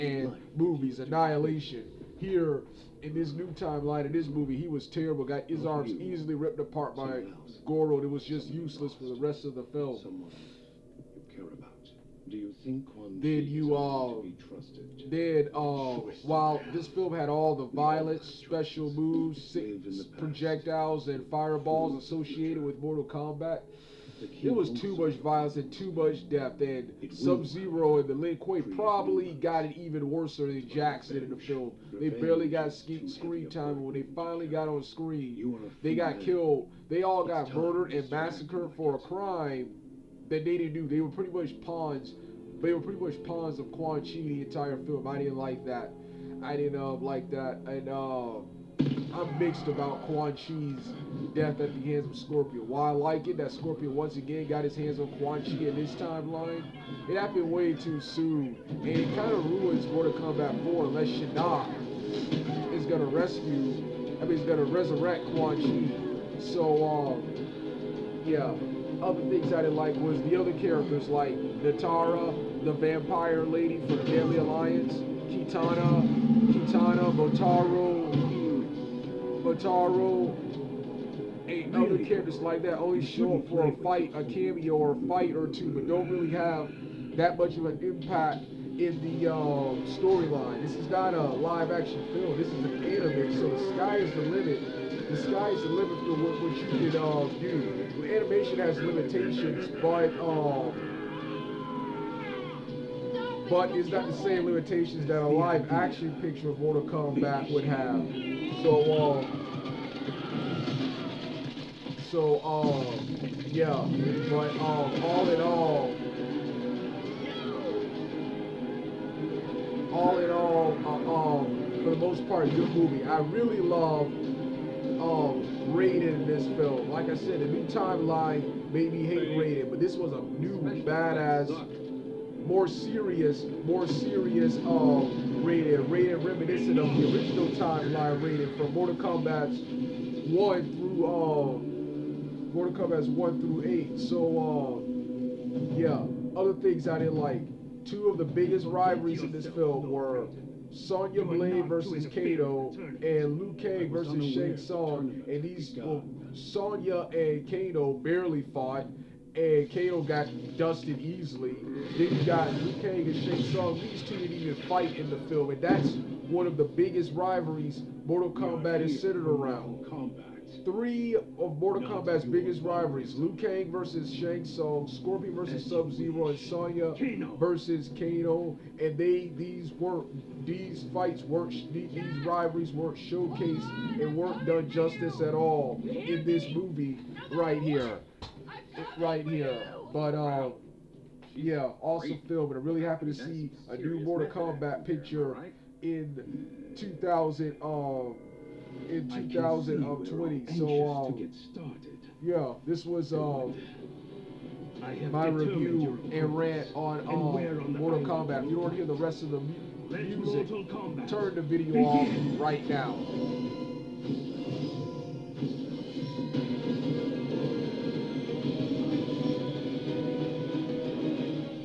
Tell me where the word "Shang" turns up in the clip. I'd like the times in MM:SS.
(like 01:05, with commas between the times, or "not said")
02:34, 02:43, 02:54.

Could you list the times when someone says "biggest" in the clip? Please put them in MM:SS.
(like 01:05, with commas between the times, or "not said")
02:28, 02:46, 02:52.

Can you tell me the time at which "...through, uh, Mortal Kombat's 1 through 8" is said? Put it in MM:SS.
02:20.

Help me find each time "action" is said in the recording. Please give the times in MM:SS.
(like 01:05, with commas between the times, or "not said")
01:31, 01:45.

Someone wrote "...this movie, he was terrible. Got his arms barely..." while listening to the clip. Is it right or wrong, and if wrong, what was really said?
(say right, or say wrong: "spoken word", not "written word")
wrong: "easily", not "barely".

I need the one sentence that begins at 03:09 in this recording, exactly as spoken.
But um, yeah, awesome film, and I'm really happy to see a new Mortal Kombat picture in 2000.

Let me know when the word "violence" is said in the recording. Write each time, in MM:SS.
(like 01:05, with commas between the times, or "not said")
00:17, 00:25.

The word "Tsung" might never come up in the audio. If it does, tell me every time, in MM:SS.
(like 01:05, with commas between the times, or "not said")
02:34, 02:43, 02:54.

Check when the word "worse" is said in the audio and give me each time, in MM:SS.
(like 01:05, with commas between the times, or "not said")
00:30.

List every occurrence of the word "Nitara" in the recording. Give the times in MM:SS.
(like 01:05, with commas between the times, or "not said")
01:11.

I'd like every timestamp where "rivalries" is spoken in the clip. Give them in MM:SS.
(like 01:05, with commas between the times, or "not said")
02:28, 02:47, 02:52, 03:02.